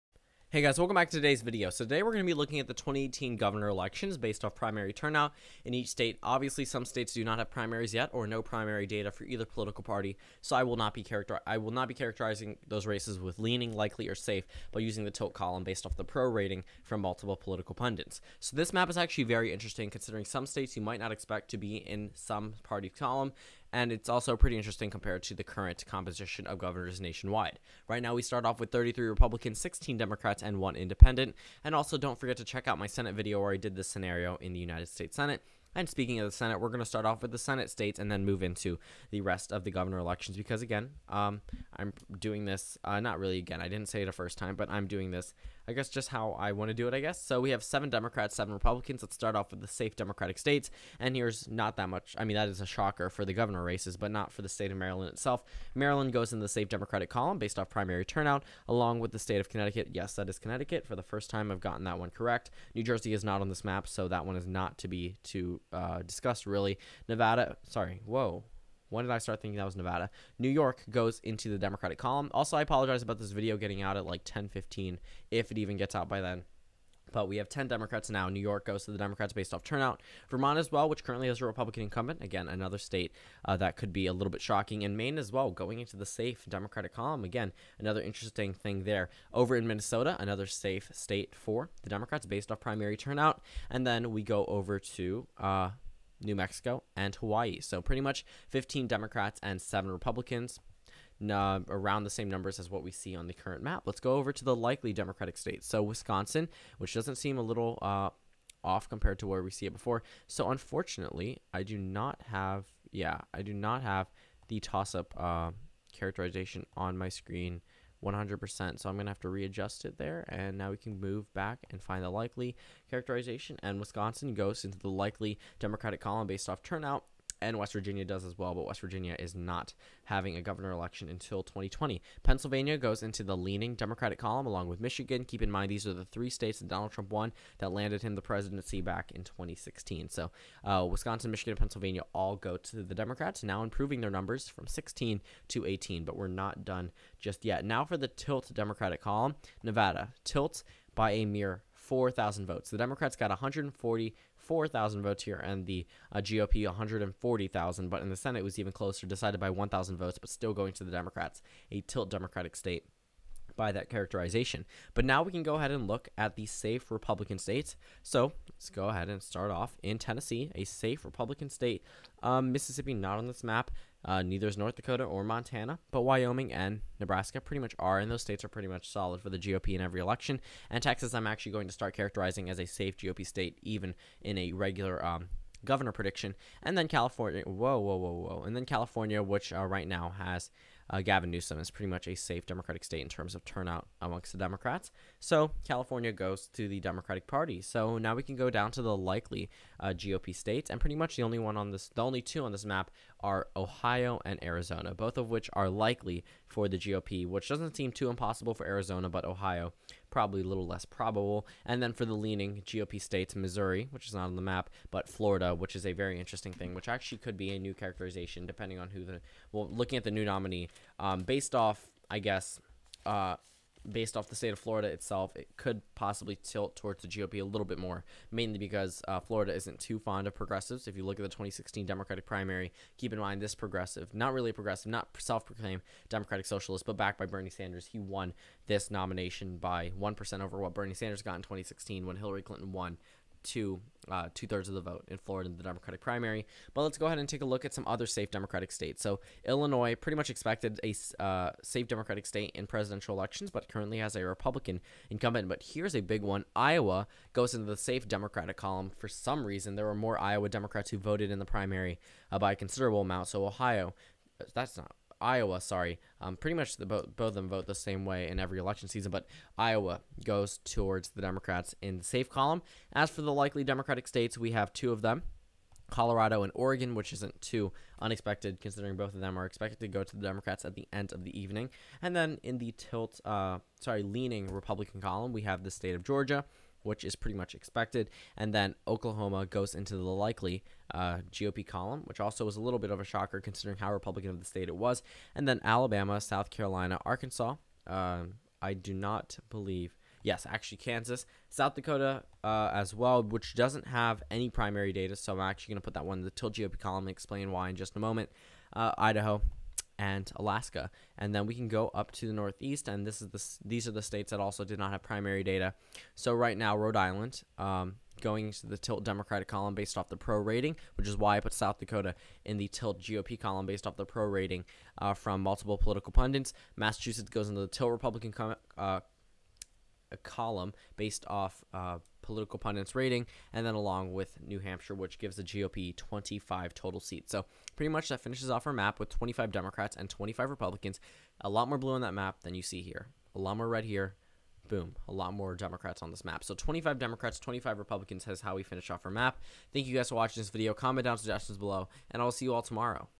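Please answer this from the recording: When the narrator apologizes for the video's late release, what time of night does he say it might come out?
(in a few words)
10:15.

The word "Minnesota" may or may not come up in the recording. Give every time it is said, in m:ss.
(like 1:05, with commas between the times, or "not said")
1:29.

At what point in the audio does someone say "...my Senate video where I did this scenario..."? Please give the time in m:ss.
0:32.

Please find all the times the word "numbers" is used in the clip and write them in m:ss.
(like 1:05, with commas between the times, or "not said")
1:42, 2:24.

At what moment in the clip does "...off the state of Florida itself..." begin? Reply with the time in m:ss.
3:44.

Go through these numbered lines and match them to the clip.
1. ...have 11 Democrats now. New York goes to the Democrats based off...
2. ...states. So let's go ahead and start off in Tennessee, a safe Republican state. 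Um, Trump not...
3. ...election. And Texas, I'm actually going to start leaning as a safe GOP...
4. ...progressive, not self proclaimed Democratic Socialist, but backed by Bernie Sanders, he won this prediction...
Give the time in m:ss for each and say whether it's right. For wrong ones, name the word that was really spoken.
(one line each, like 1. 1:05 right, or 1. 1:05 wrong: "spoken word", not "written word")
1. 1:17 wrong: "10", not "11"
2. 2:47 wrong: "Mississippi", not "Trump"
3. 3:00 wrong: "characterizing", not "leaning"
4. 3:54 wrong: "nomination", not "prediction".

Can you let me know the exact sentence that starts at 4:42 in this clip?
And then in the tilt, uh, sorry, leaning Republican column, we have the state of Georgia, which is pretty much expected.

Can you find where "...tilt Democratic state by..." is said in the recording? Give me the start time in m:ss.
2:41.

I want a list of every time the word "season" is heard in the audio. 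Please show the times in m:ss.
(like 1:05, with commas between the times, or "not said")
4:28.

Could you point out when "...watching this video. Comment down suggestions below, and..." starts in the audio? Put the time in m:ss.
5:50.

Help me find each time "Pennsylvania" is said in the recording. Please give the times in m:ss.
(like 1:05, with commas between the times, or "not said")
2:12, 2:21.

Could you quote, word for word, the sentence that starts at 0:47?
So we have seven Democrats, seven Republicans.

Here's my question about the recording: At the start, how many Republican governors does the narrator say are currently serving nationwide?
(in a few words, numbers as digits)
33.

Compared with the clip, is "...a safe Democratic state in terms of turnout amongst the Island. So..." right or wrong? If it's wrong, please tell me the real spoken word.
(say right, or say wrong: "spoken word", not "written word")
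wrong: "Democrats", not "Island".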